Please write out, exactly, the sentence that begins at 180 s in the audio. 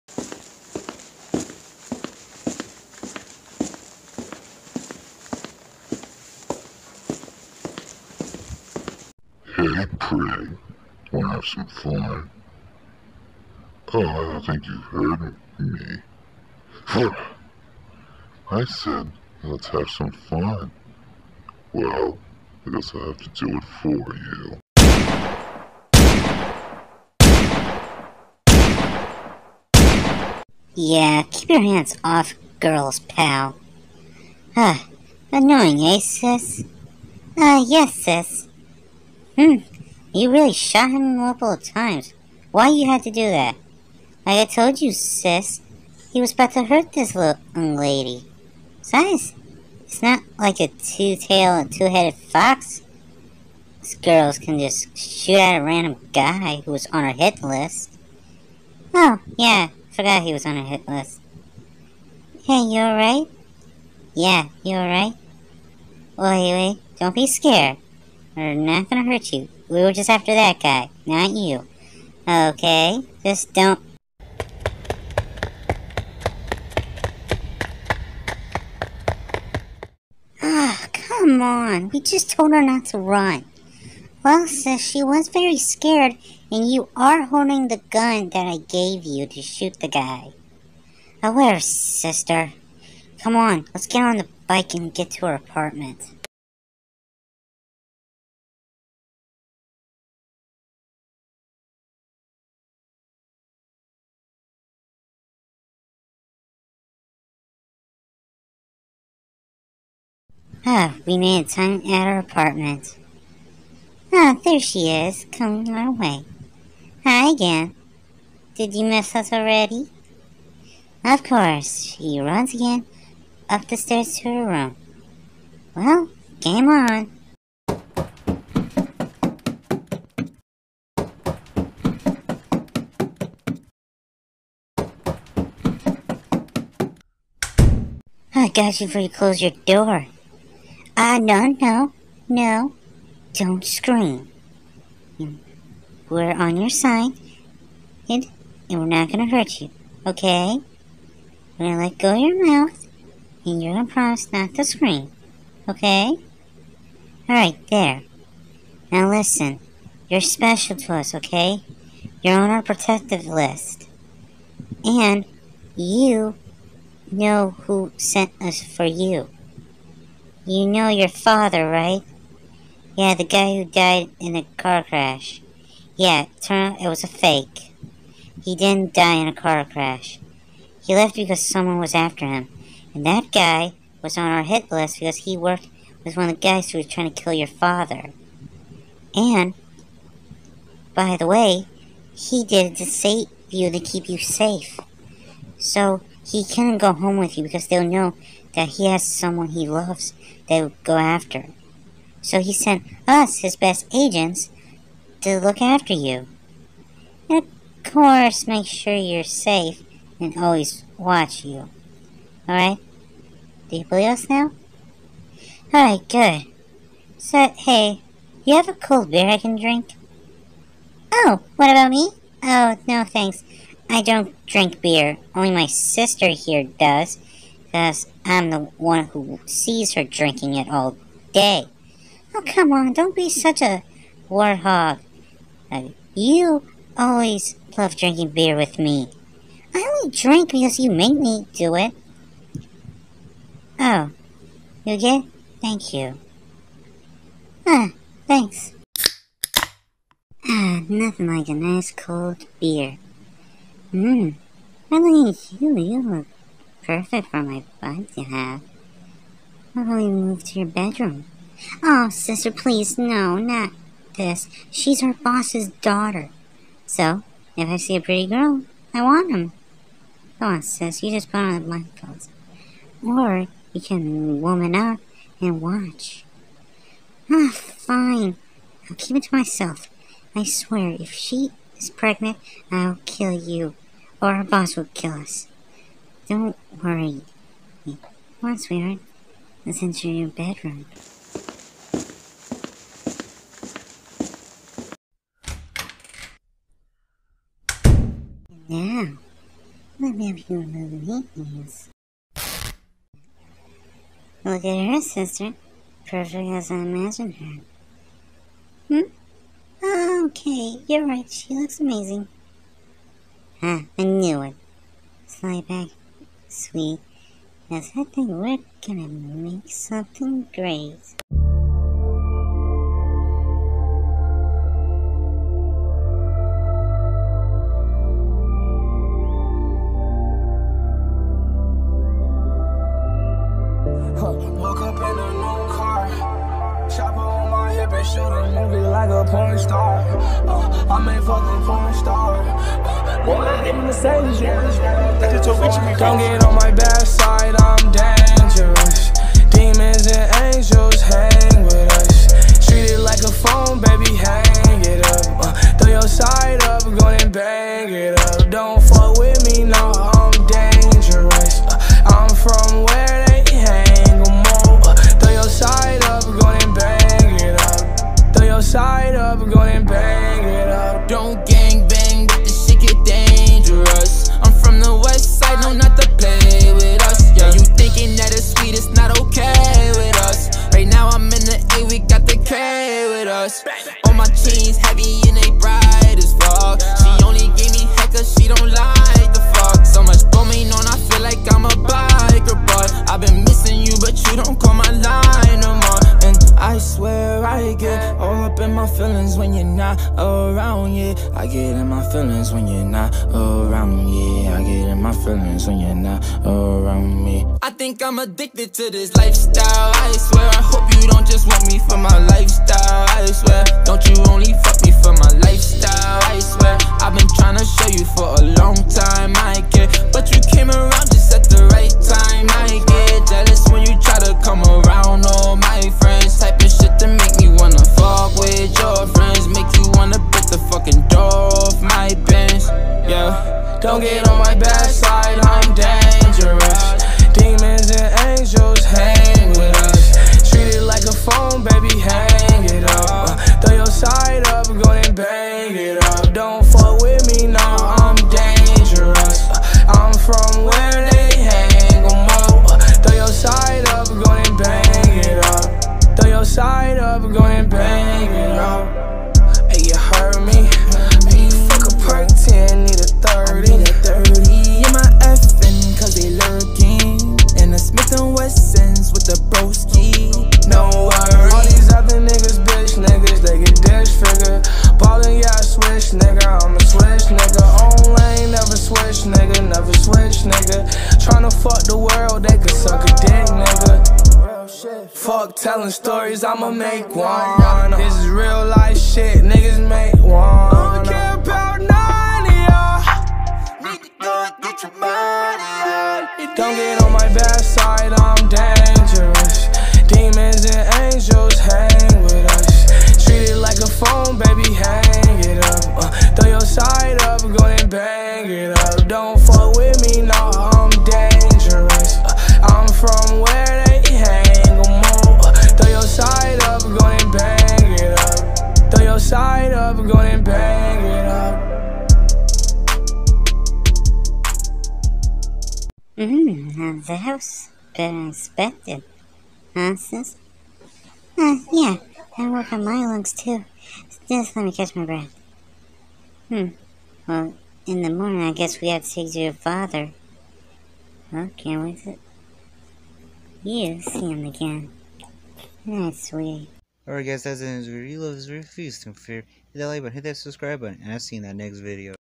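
He left because someone was after him.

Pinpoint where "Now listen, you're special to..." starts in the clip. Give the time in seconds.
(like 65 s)
158 s.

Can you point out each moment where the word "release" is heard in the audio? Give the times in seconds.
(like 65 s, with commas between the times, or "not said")
not said.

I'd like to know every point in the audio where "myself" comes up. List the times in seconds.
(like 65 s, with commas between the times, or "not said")
279 s.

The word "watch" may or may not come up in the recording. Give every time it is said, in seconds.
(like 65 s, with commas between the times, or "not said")
210 s, 275 s.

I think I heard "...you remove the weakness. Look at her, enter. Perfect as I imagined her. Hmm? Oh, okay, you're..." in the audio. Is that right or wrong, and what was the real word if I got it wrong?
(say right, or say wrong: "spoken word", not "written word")
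wrong: "sister", not "enter".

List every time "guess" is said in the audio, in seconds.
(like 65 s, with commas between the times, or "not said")
22 s, 538 s.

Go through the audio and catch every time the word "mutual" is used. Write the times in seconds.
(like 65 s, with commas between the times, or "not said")
not said.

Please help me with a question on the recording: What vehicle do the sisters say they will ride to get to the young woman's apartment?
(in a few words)
bike.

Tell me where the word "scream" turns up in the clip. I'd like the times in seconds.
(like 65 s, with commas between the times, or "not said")
143 s, 154 s.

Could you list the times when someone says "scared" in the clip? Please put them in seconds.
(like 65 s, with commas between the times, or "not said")
67 s, 85 s.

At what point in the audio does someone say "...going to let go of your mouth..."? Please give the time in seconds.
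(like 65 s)
151 s.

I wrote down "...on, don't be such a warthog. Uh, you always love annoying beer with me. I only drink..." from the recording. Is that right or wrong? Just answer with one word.
wrong.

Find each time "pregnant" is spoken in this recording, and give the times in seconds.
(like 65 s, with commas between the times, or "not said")
281 s.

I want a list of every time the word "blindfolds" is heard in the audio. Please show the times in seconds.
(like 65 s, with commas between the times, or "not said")
271 s.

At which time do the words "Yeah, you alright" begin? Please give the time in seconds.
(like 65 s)
64 s.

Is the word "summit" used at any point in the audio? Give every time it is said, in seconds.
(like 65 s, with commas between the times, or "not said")
not said.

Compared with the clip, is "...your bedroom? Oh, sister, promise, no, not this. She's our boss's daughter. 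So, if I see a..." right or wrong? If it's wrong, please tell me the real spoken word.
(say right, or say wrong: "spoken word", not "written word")
wrong: "please", not "promise".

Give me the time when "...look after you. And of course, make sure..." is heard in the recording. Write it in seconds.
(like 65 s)
205 s.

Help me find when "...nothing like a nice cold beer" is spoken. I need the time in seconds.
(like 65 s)
250 s.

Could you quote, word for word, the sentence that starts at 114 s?
Ah, there she is, coming our way.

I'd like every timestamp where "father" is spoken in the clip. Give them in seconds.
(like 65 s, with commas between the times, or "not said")
171 s, 187 s, 539 s.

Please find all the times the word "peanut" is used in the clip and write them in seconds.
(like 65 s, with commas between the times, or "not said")
not said.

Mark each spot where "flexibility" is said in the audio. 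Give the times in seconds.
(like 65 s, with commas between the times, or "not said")
not said.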